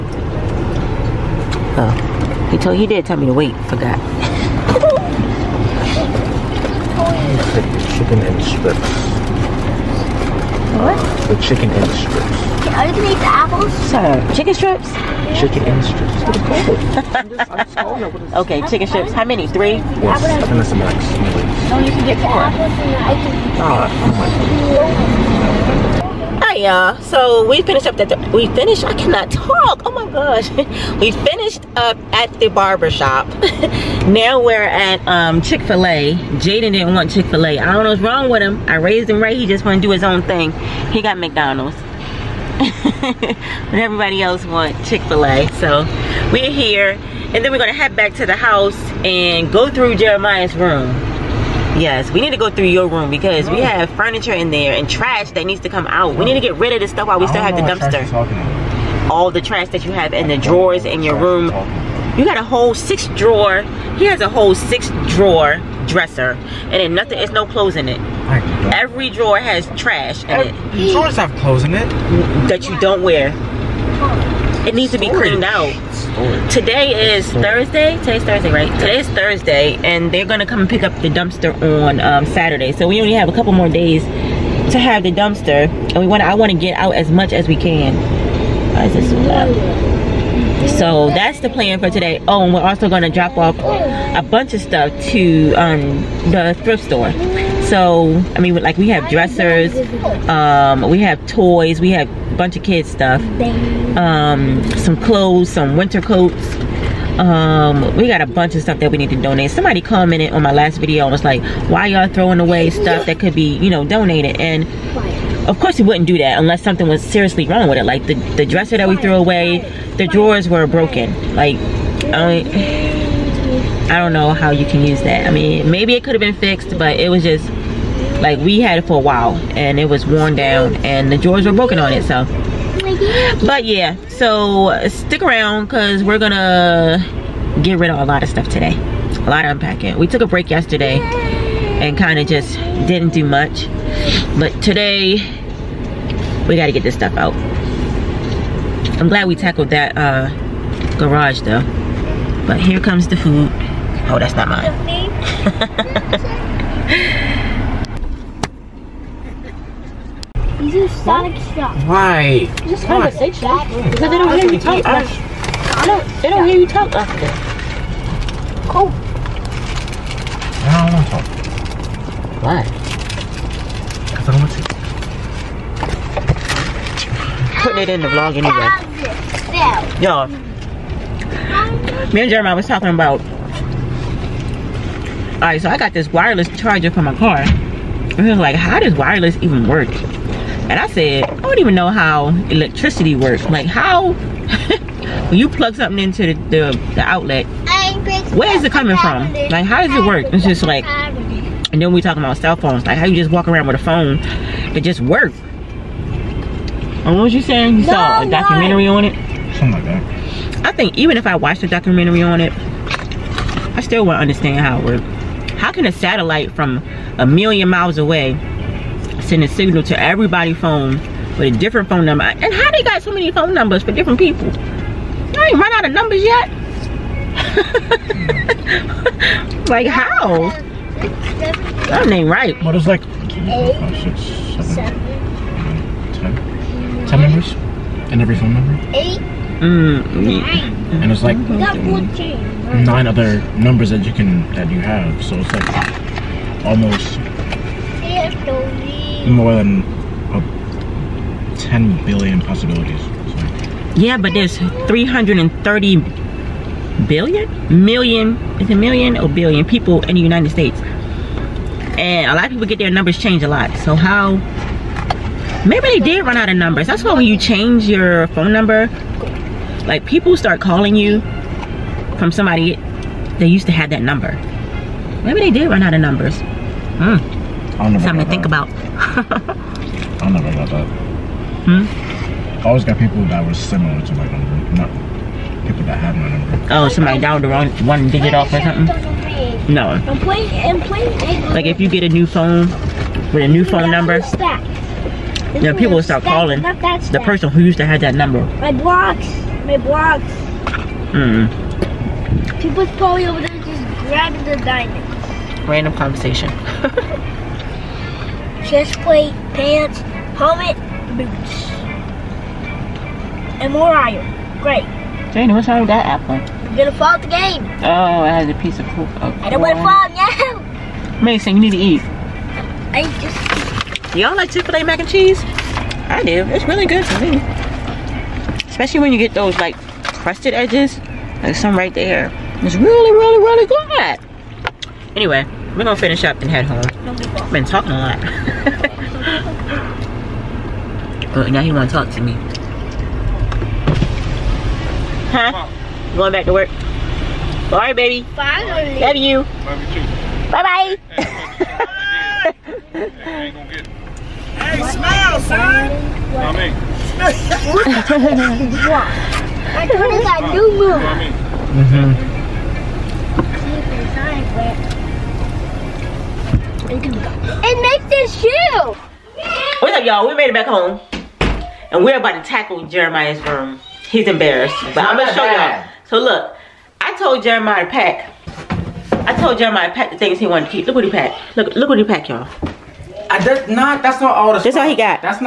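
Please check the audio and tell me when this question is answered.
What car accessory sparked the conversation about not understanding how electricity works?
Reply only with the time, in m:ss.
3:06.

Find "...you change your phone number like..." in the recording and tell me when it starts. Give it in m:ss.
4:27.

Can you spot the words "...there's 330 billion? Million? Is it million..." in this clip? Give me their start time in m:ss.
4:14.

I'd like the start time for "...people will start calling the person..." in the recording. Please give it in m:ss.
4:55.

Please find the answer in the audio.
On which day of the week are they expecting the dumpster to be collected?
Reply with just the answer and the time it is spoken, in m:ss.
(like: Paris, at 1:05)
Saturday, at 1:22.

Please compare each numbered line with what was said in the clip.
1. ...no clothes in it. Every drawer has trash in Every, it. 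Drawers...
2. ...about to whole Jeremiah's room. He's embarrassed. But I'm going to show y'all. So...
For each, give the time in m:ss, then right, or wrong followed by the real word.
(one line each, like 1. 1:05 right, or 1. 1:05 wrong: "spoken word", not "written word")
1. 1:07 right
2. 6:12 wrong: "tackle", not "whole".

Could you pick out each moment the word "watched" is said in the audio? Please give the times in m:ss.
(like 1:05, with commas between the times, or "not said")
3:31.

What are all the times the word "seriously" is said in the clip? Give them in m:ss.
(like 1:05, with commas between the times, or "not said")
1:57.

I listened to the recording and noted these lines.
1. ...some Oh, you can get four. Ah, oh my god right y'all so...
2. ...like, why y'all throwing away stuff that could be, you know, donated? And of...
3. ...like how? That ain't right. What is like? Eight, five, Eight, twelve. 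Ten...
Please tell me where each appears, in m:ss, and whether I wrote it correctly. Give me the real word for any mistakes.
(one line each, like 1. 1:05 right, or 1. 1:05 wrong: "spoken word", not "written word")
1. 0:20 right
2. 1:51 right
3. 3:49 wrong: "ten", not "twelve".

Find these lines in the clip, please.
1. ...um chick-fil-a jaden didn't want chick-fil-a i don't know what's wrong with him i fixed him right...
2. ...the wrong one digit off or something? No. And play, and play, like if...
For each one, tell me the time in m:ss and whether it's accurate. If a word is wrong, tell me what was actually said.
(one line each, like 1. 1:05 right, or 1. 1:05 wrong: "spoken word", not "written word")
1. 0:35 wrong: "raised", not "fixed"
2. 4:47 right.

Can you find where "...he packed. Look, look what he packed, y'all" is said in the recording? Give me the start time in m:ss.
6:21.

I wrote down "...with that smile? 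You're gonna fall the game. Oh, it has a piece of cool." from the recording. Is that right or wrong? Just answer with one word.
wrong.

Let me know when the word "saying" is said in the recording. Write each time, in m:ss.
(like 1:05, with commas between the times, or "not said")
3:27.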